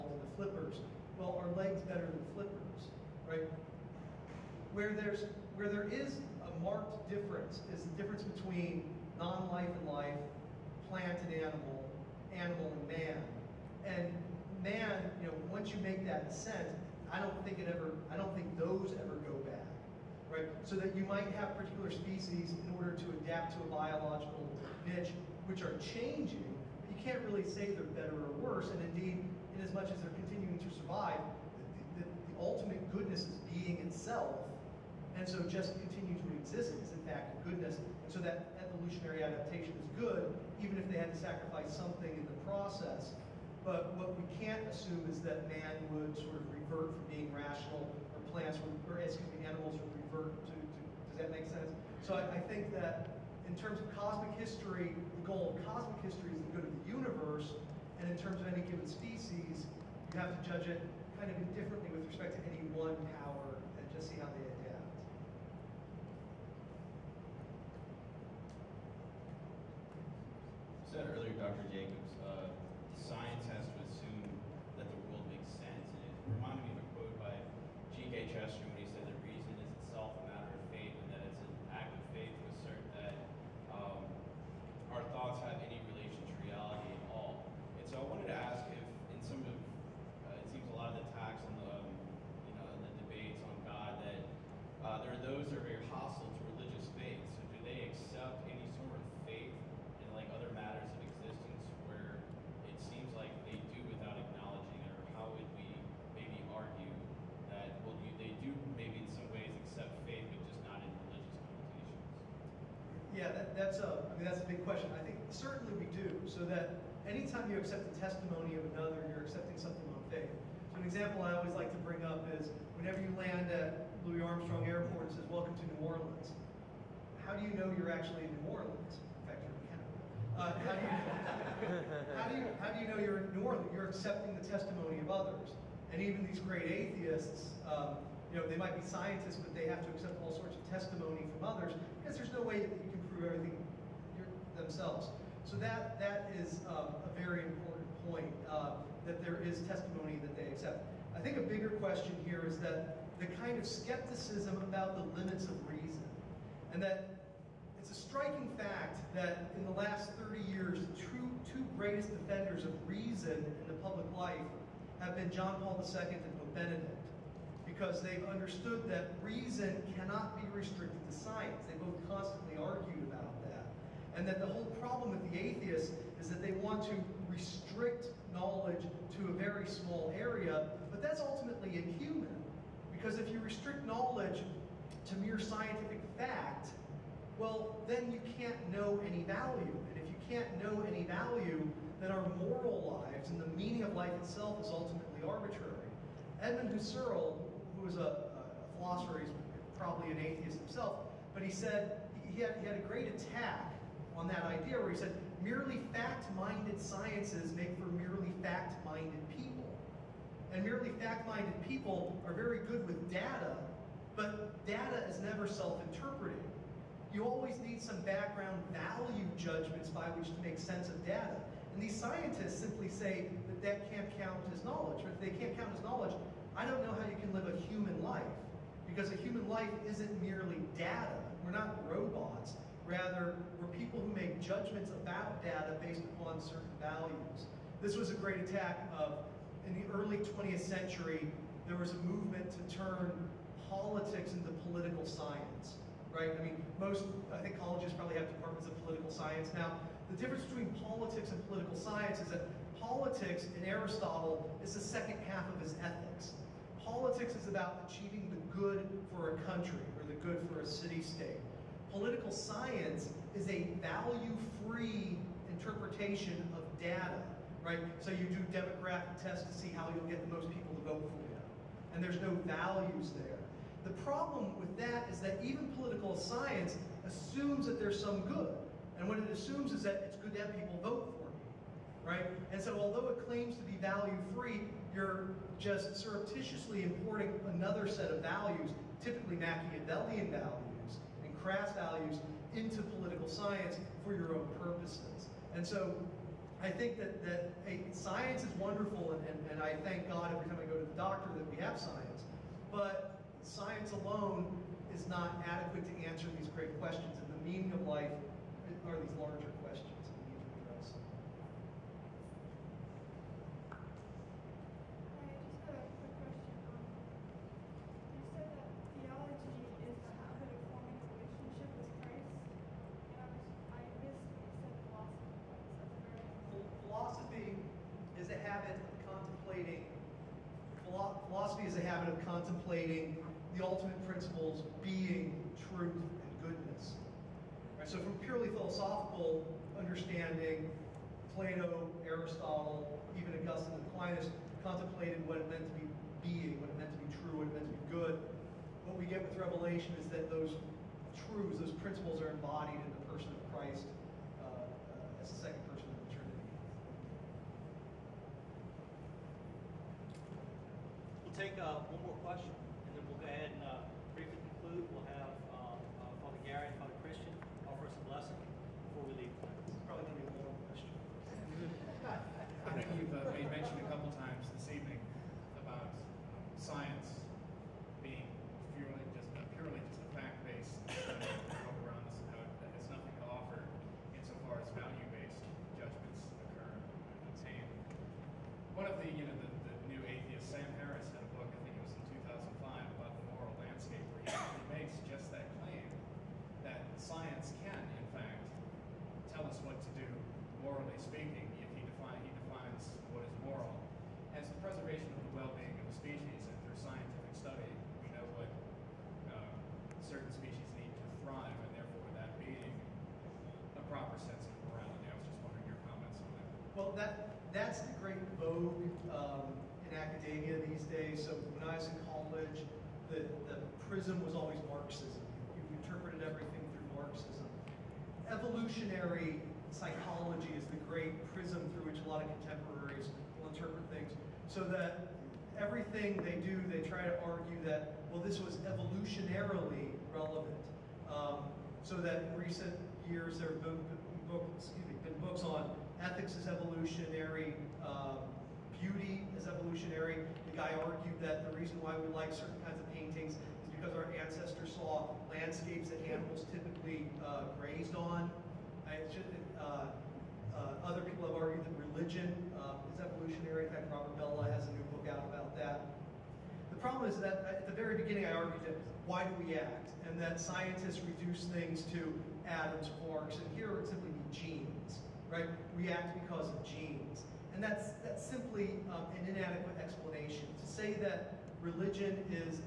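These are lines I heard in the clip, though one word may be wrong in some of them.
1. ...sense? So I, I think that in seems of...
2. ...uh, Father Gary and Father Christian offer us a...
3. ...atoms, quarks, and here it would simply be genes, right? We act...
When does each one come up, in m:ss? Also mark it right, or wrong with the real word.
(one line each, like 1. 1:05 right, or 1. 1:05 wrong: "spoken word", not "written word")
1. 0:51 wrong: "terms", not "seems"
2. 6:06 right
3. 7:52 right.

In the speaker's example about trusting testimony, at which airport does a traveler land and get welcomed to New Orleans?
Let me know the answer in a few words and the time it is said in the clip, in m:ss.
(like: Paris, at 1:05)
Louis Armstrong Airport, at 2:04.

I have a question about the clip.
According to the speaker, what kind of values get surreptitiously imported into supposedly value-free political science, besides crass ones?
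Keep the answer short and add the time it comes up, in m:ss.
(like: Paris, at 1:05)
Machiavellian values, at 4:49.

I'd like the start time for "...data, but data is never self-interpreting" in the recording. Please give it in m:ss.
3:33.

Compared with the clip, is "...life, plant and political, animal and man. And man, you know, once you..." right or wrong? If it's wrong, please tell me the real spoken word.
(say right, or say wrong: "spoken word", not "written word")
wrong: "animal", not "political".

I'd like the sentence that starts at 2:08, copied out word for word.
In fact, you're uh, how, do you, how, do you, how do you know you're northern?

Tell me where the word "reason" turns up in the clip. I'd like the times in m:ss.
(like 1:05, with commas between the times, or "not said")
1:19, 2:35, 2:42, 2:49, 7:31.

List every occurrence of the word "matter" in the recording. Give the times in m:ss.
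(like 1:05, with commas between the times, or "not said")
1:20, 1:40.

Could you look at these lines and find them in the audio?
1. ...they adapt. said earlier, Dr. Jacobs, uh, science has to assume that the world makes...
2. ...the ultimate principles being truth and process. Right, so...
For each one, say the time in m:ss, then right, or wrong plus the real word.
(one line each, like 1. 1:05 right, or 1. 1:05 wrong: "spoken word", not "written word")
1. 1:04 right
2. 5:33 wrong: "goodness", not "process".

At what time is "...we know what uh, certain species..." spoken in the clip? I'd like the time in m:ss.
6:48.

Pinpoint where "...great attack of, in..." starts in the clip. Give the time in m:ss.
3:58.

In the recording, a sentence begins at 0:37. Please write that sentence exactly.
And so that evolutionary adaptation is good, even if they had to sacrifice something in the process.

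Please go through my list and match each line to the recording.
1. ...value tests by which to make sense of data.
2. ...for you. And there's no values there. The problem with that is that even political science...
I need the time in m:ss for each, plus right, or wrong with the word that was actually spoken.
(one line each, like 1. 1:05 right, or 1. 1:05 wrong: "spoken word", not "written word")
1. 3:38 wrong: "judgments", not "tests"
2. 4:31 right.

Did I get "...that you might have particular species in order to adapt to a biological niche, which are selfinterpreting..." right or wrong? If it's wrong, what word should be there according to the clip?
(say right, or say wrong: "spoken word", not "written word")
wrong: "changing", not "selfinterpreting".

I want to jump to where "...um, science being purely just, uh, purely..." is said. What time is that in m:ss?
6:15.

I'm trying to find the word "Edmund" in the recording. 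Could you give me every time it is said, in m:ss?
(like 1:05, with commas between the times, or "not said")
3:16.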